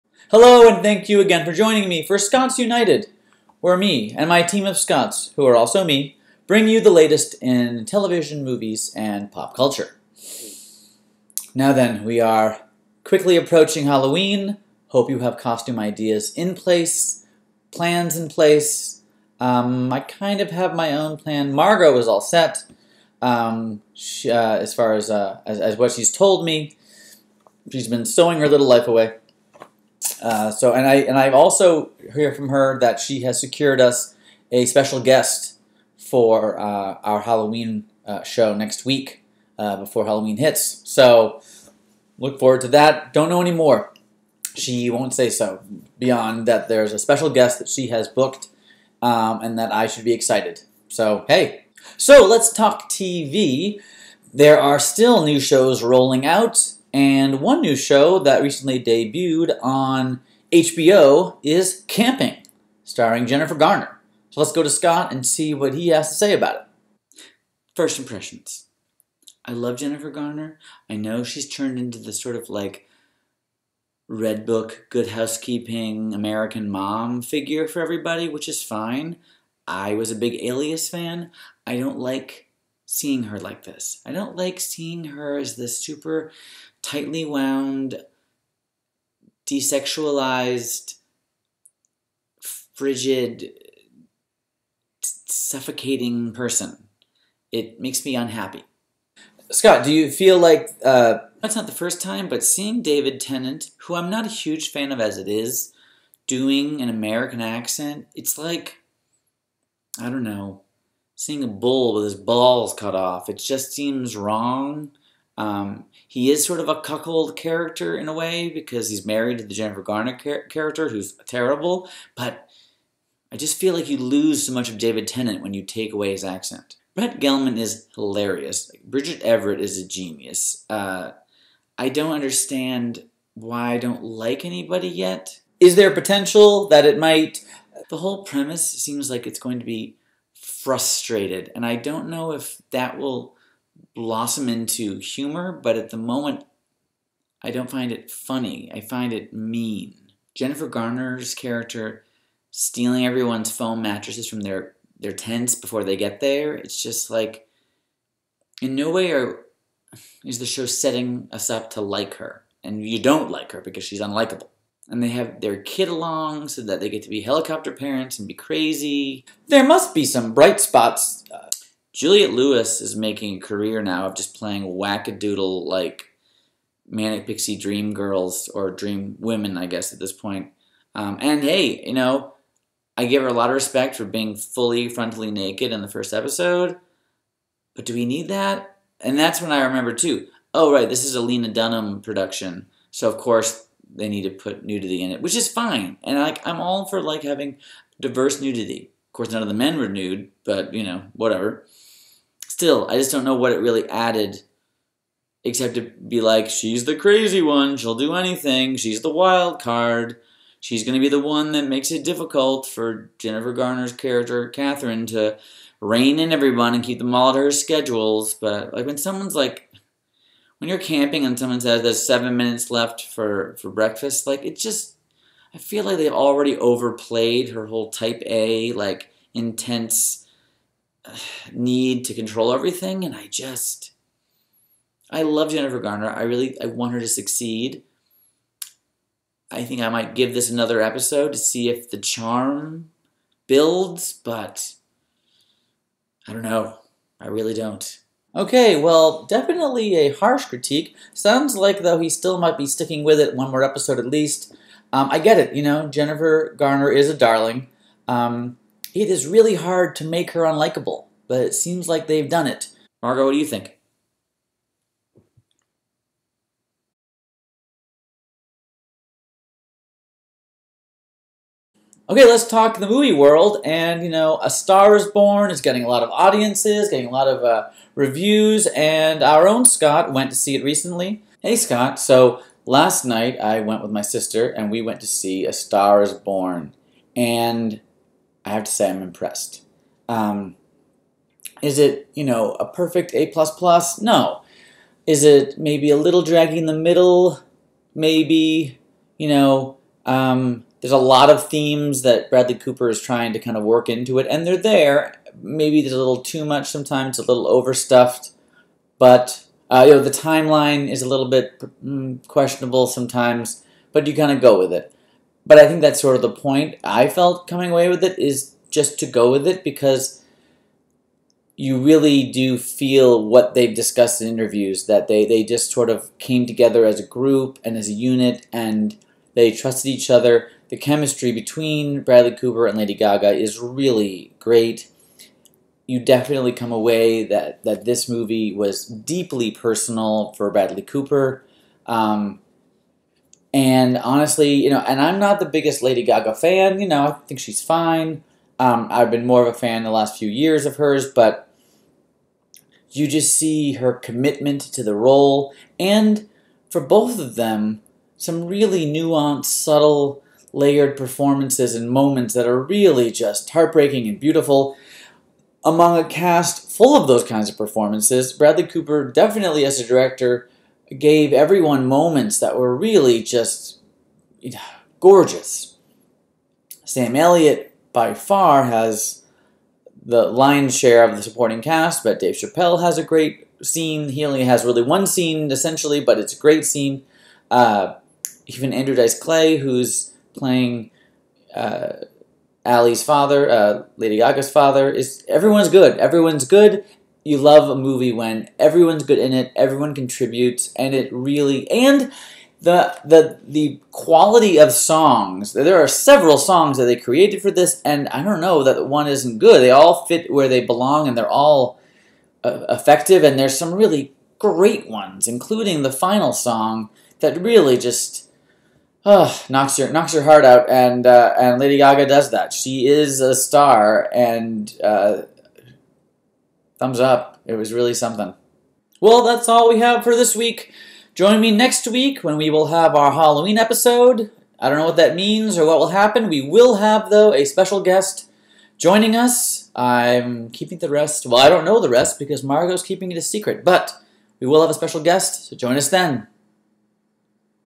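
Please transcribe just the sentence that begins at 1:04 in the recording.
So let's go to Scott and see what he has to say about it.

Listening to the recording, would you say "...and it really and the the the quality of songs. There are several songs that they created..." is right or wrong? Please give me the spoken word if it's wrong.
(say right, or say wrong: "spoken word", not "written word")
right.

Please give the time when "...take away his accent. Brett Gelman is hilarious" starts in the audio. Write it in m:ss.
2:05.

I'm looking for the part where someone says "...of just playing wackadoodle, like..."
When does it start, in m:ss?
2:54.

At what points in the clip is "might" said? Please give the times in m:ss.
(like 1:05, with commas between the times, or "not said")
2:16, 3:59, 4:12.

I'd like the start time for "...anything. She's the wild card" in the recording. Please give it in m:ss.
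3:28.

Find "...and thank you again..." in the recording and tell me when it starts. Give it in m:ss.
0:00.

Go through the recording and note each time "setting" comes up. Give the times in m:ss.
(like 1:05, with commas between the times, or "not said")
2:40.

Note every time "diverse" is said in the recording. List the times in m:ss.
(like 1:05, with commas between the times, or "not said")
3:17.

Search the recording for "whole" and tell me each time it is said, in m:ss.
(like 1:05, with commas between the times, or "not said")
2:17, 3:47.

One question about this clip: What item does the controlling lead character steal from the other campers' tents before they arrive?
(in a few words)
foam mattresses.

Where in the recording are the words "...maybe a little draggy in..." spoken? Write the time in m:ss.
4:55.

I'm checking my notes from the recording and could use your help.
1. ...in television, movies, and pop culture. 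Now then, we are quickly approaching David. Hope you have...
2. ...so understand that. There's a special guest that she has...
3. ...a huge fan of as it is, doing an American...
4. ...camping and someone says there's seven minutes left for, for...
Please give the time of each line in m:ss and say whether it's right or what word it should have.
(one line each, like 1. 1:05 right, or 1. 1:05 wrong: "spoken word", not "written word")
1. 0:07 wrong: "Halloween", not "David"
2. 0:45 wrong: "beyond", not "understand"
3. 1:44 right
4. 3:40 right.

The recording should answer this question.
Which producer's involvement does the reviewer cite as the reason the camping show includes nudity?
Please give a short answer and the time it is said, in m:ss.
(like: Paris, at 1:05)
Lena Dunham, at 3:11.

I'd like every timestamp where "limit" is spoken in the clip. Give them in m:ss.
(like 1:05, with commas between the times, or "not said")
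not said.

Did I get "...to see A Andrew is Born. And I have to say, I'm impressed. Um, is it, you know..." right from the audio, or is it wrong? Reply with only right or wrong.
wrong.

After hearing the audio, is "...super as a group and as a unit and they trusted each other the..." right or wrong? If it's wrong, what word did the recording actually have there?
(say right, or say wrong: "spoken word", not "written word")
wrong: "together", not "super".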